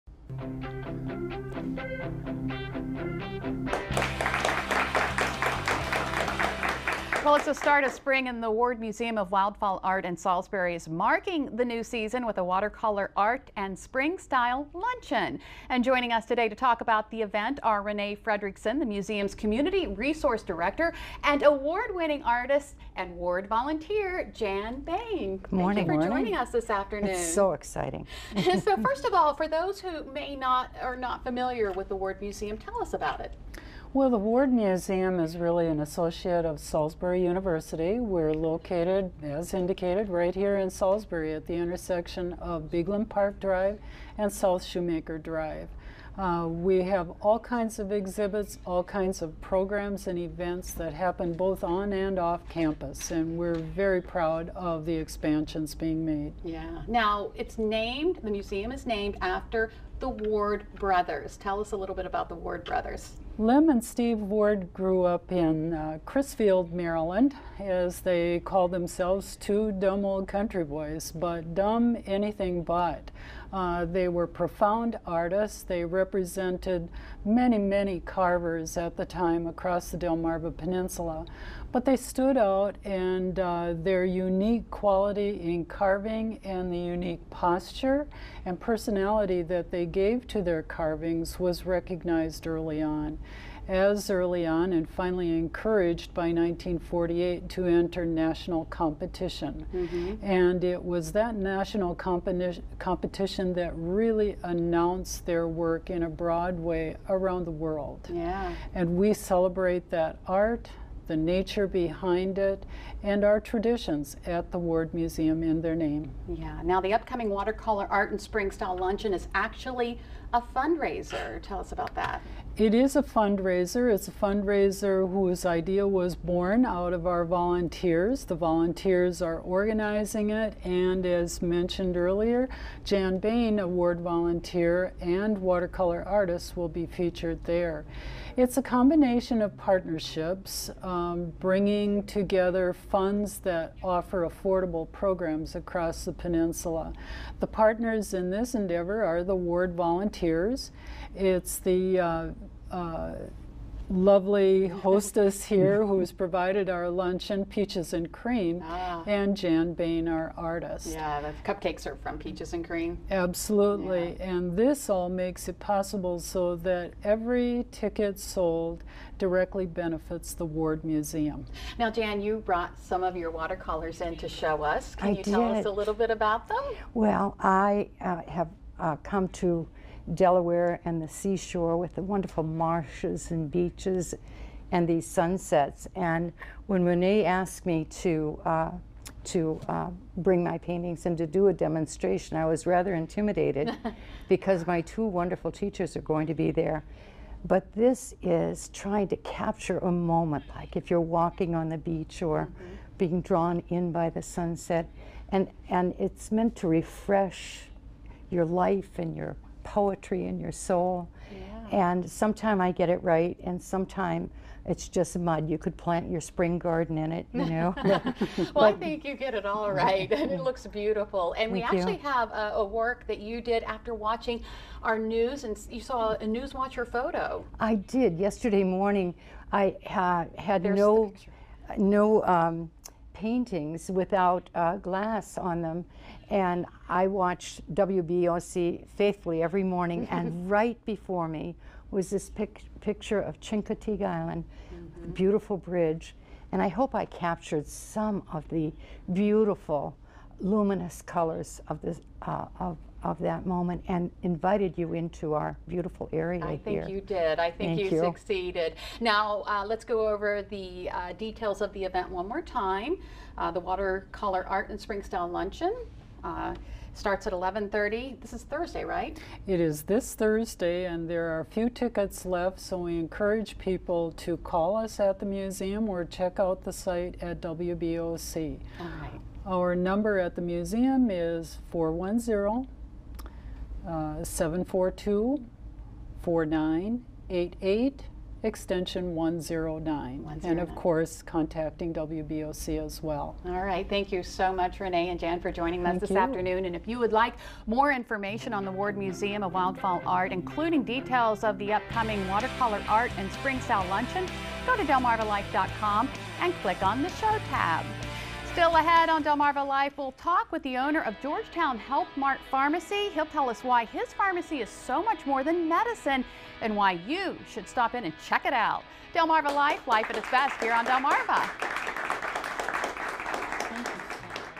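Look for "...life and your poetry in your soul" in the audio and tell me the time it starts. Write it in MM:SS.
03:28.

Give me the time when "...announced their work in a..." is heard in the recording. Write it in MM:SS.
01:44.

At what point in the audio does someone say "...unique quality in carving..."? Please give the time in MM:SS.
01:24.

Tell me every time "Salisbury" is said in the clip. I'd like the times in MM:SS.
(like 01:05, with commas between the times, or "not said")
00:10, 00:36, 00:40.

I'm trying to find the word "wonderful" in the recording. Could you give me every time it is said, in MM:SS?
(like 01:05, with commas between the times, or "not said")
03:02, 03:15.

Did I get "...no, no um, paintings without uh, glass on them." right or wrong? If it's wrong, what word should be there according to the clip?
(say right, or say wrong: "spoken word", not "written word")
right.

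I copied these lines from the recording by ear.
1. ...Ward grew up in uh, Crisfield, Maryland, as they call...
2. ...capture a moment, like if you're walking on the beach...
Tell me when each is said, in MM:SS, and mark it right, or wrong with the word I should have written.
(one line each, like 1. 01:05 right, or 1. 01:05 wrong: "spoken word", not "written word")
1. 01:04 right
2. 03:19 right.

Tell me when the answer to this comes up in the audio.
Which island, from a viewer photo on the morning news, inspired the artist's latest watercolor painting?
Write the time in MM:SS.
04:03.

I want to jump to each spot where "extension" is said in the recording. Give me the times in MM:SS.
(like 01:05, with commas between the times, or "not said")
04:48.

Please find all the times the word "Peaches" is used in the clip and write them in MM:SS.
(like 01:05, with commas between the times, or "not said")
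02:37, 02:42.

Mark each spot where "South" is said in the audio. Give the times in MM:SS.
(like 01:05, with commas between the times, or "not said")
00:44.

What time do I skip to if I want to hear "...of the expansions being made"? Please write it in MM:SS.
00:54.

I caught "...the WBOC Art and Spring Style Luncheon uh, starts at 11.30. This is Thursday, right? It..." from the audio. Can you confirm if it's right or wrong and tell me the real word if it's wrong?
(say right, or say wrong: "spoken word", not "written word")
wrong: "Watercolor", not "WBOC".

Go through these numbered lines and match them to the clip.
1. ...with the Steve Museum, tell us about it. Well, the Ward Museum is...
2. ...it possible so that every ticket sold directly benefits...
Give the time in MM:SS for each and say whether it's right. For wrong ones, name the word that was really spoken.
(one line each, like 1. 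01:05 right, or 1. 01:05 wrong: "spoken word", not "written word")
1. 00:31 wrong: "Ward", not "Steve"
2. 02:45 right.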